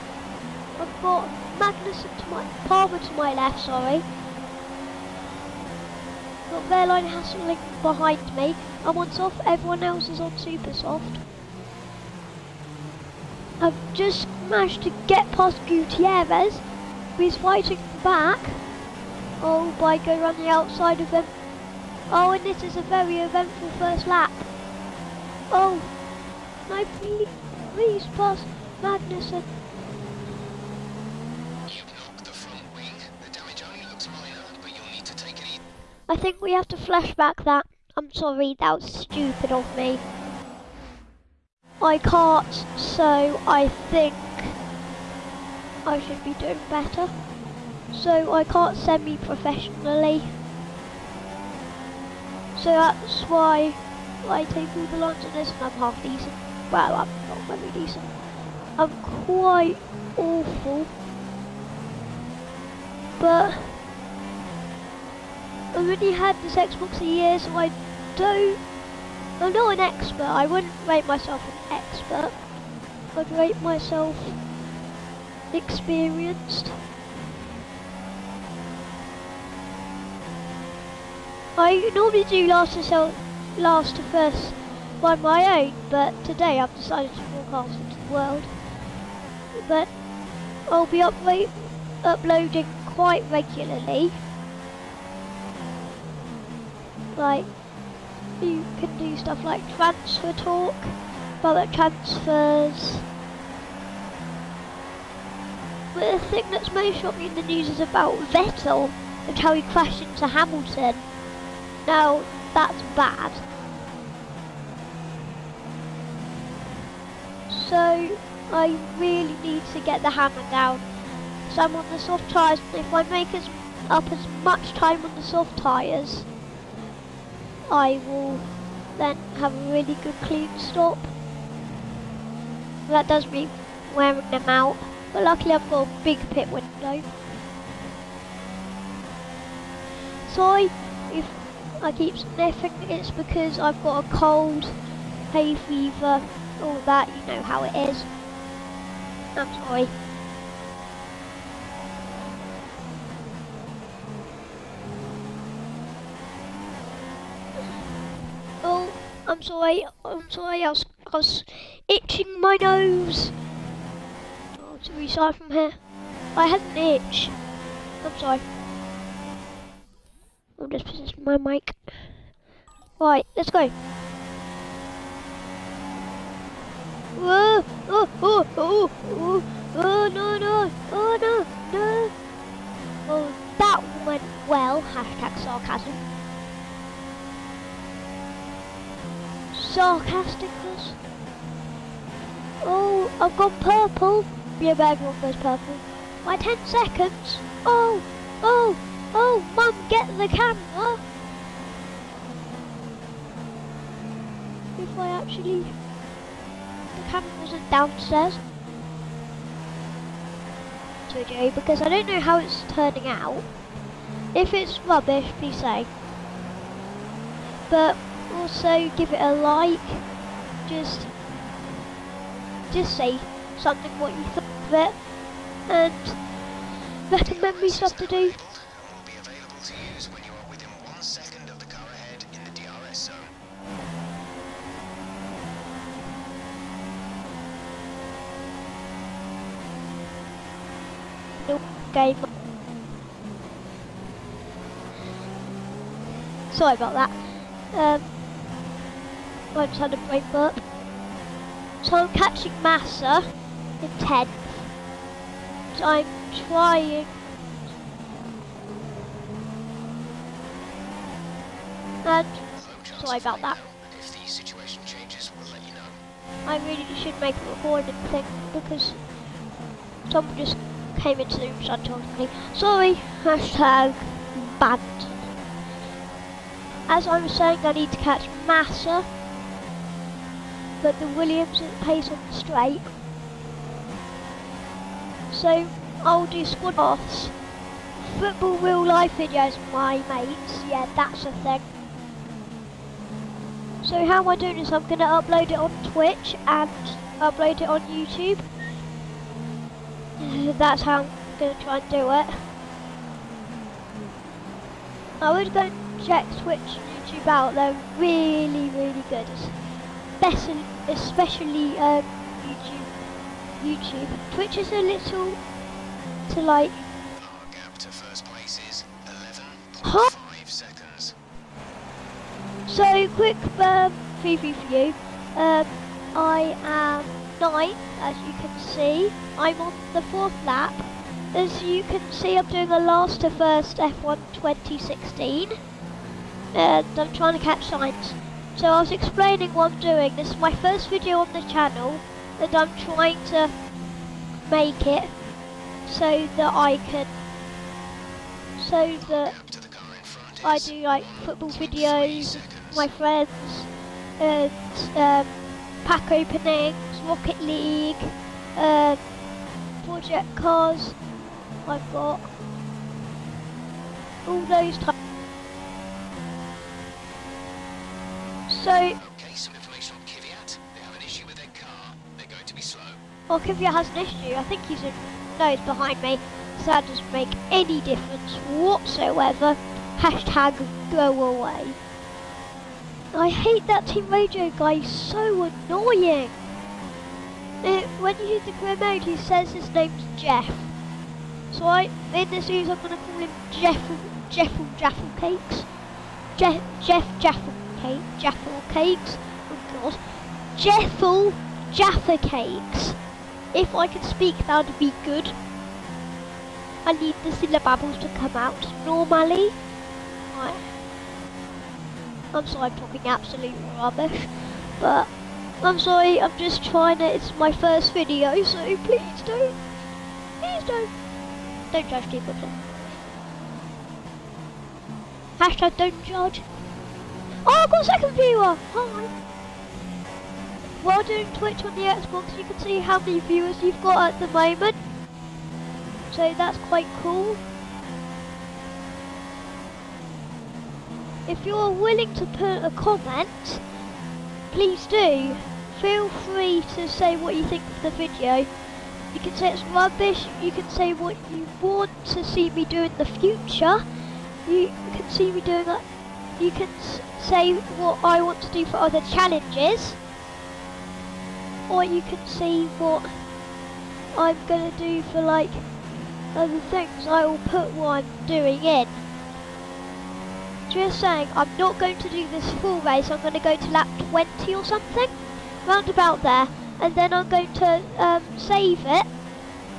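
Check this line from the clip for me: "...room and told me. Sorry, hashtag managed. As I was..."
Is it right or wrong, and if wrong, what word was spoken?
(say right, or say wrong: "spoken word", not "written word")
wrong: "banned", not "managed".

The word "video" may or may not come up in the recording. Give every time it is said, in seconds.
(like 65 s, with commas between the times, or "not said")
289 s, 340 s, 351 s, 417 s, 447 s.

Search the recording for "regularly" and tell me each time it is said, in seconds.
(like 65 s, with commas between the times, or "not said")
93 s.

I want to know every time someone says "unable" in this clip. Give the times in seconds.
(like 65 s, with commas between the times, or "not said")
not said.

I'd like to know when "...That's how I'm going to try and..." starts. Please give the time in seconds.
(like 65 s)
300 s.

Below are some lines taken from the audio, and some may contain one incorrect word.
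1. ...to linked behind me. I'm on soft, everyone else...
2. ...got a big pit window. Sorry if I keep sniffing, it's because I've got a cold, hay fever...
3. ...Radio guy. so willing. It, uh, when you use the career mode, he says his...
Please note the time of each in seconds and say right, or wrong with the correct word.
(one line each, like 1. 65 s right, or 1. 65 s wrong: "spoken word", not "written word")
1. 7 s right
2. 135 s right
3. 384 s wrong: "annoying", not "willing".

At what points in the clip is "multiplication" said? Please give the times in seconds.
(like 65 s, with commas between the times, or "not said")
not said.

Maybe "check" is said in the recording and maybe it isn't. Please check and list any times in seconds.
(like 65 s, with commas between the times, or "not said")
306 s.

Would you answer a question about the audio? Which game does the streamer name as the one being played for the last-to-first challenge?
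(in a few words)
F1 2016.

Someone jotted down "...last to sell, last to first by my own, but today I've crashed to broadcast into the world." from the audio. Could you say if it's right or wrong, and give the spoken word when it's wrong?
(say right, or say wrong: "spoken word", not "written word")
wrong: "decided", not "crashed".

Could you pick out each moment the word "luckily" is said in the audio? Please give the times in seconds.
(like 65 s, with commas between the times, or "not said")
135 s.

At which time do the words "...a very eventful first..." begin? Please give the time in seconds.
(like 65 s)
22 s.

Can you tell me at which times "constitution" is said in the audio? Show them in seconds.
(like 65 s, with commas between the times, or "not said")
not said.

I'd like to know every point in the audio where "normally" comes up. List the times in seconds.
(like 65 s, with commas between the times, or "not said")
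81 s, 408 s.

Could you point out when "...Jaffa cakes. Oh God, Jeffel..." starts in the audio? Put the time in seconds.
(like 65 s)
398 s.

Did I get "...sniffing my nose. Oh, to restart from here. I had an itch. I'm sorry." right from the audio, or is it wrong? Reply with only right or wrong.
wrong.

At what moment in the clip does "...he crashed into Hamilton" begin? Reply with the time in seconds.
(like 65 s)
109 s.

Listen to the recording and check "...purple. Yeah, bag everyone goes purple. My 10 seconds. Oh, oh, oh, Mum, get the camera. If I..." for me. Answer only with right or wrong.
right.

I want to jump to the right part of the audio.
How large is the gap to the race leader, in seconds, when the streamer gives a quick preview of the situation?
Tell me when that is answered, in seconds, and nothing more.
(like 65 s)
319 s.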